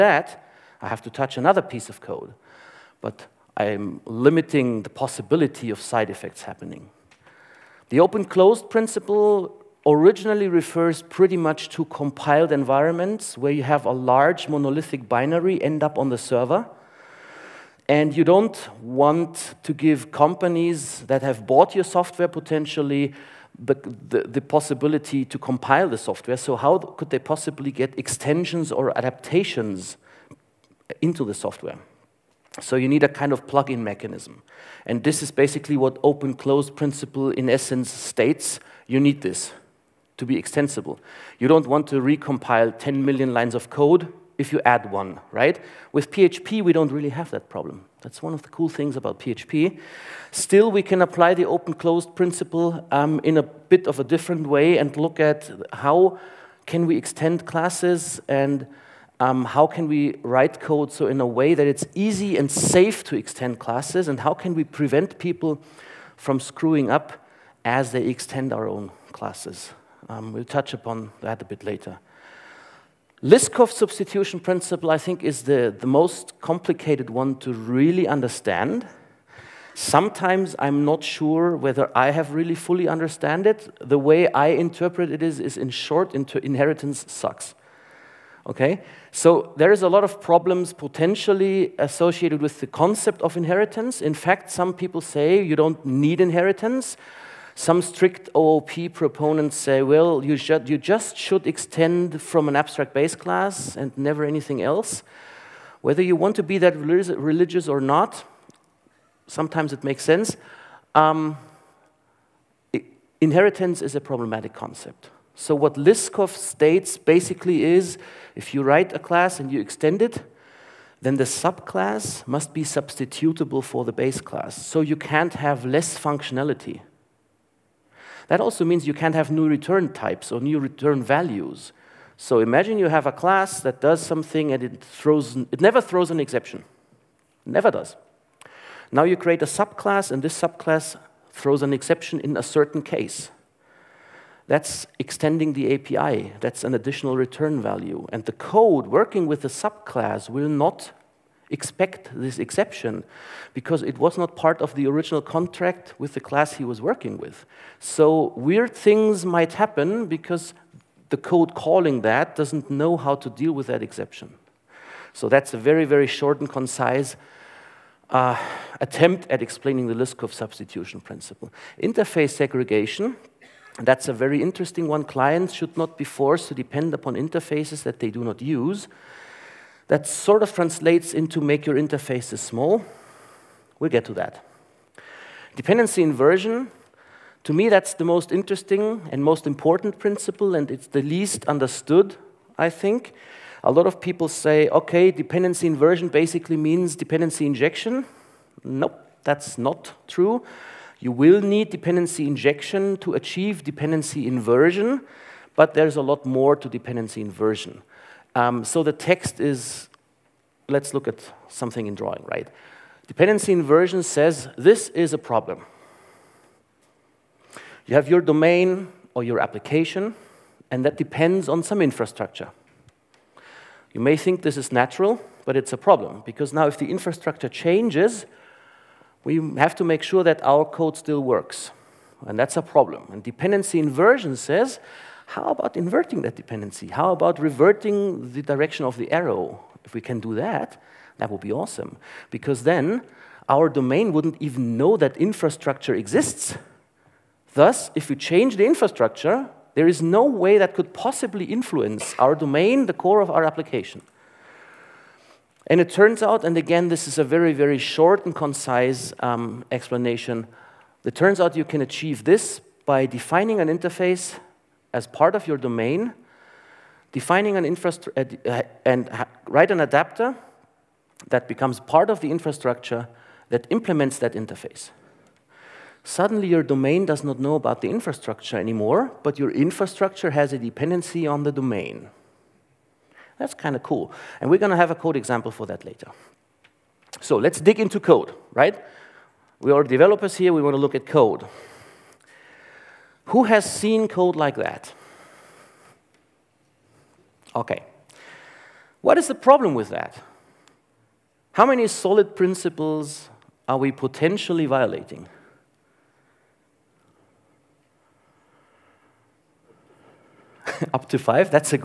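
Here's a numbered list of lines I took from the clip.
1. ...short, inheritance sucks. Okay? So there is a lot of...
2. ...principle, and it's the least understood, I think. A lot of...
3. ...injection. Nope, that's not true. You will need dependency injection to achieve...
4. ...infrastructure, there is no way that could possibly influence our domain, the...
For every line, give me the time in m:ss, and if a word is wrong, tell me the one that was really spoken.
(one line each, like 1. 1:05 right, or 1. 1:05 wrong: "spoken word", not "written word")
1. 1:25 right
2. 3:09 right
3. 3:17 right
4. 4:08 right.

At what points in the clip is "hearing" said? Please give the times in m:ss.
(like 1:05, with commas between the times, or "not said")
not said.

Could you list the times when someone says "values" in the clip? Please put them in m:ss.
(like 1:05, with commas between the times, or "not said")
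2:11, 2:27.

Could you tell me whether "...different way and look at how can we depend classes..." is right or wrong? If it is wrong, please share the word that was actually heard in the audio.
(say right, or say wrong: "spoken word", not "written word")
wrong: "extend", not "depend".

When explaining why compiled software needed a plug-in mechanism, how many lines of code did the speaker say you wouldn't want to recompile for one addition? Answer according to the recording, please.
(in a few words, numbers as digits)
10 million.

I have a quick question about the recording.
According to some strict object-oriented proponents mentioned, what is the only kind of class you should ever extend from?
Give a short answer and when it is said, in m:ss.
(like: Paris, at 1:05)
abstract base class, at 1:42.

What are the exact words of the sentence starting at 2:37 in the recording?
So weird things might happen because the code calling that doesn't know how to deal with that exception.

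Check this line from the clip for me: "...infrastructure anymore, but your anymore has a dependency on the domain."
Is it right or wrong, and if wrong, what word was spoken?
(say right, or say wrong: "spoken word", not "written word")
wrong: "infrastructure", not "anymore".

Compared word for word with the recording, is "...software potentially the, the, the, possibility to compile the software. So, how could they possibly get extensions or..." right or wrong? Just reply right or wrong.
right.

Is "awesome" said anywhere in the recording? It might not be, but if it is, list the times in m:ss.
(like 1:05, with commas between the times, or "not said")
4:01.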